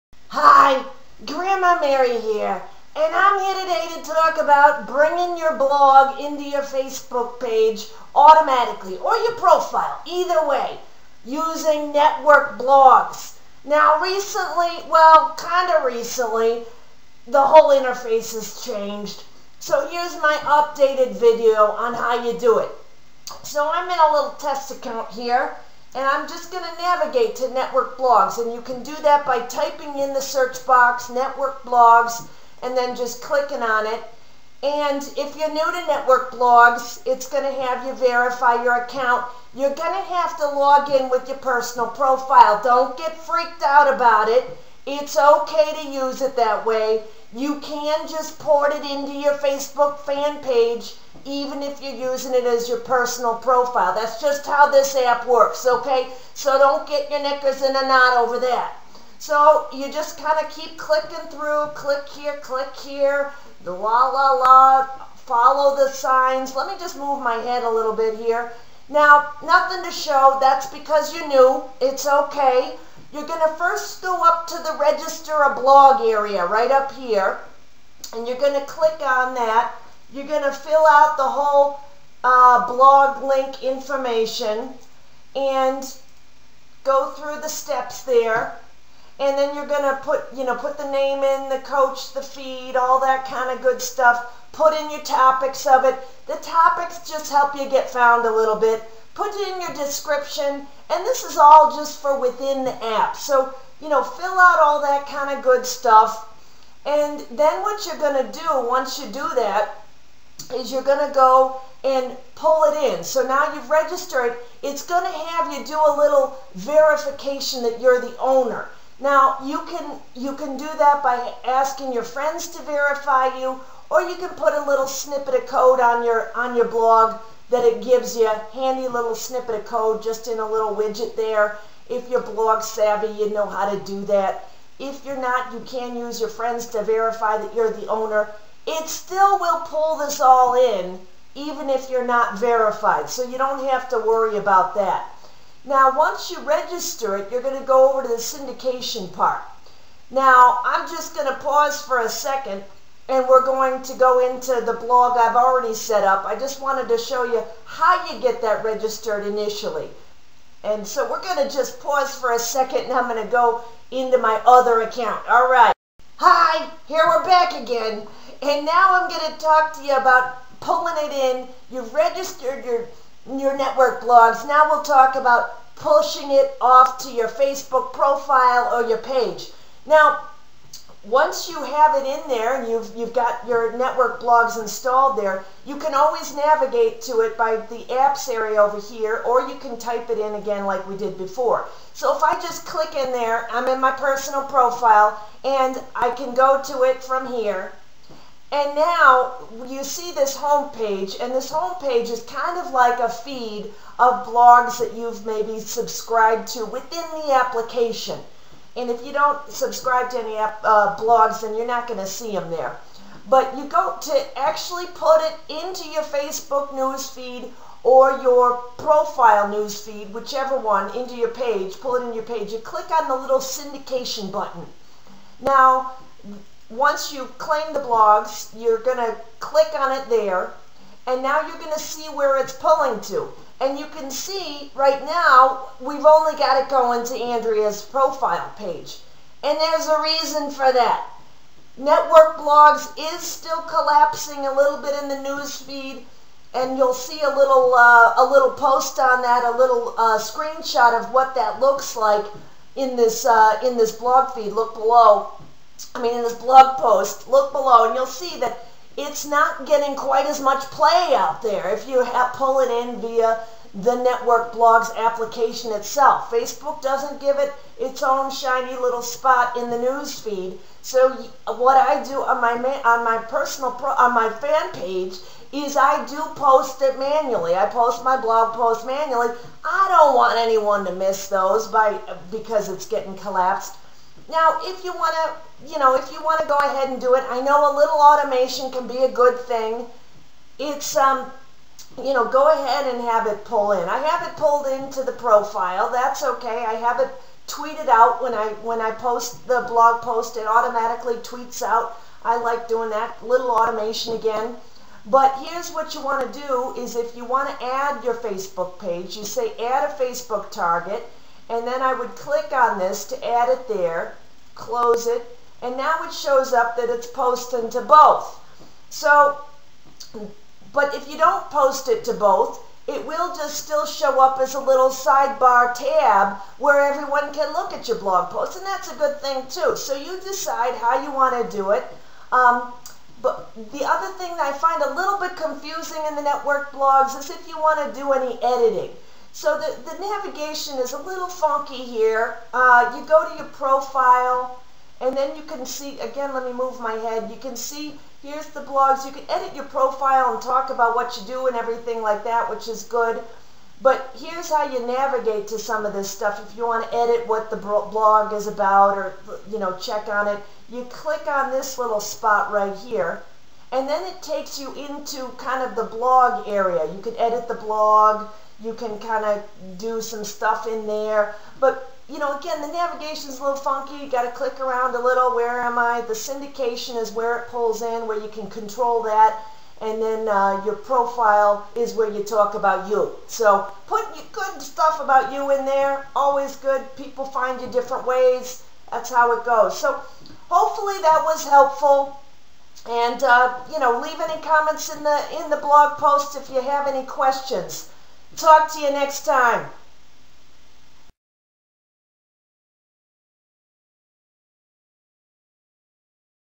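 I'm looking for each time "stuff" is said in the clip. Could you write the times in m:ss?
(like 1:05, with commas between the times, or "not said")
1:33, 1:45, 5:56, 6:10, 6:24.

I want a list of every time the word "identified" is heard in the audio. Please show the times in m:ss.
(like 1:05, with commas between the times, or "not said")
not said.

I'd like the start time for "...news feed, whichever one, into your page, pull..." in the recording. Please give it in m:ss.
3:39.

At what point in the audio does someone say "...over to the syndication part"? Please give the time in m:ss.
2:27.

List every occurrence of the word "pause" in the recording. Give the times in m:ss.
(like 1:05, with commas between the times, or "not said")
2:31, 2:41.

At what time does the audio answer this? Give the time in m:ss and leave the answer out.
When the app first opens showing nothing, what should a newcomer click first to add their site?
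1:14.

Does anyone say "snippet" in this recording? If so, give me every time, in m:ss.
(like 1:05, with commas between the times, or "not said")
2:04, 2:09.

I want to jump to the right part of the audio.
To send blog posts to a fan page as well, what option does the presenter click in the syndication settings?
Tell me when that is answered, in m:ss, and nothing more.
5:09.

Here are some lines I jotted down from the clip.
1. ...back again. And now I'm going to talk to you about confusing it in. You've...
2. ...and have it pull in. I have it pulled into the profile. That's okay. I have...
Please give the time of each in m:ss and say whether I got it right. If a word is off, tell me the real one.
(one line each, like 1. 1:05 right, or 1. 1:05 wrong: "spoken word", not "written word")
1. 2:47 wrong: "pulling", not "confusing"
2. 4:52 right.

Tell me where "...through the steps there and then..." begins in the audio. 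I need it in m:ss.
1:27.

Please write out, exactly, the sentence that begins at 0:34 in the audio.
And if you're new to network blogs, it's going to have you verify your account.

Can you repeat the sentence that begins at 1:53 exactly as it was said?
So now you've registered, it's going to have you do a little verification that you're the owner.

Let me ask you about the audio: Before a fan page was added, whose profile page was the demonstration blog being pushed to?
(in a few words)
Andrea.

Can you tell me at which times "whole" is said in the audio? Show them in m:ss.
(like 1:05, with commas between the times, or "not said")
0:17, 1:21.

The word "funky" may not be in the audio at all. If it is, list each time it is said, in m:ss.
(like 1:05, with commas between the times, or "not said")
5:41, 6:13.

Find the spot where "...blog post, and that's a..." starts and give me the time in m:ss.
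5:27.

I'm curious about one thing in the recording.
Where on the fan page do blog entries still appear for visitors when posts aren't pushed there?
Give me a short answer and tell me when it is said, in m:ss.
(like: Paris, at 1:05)
sidebar tab, at 5:24.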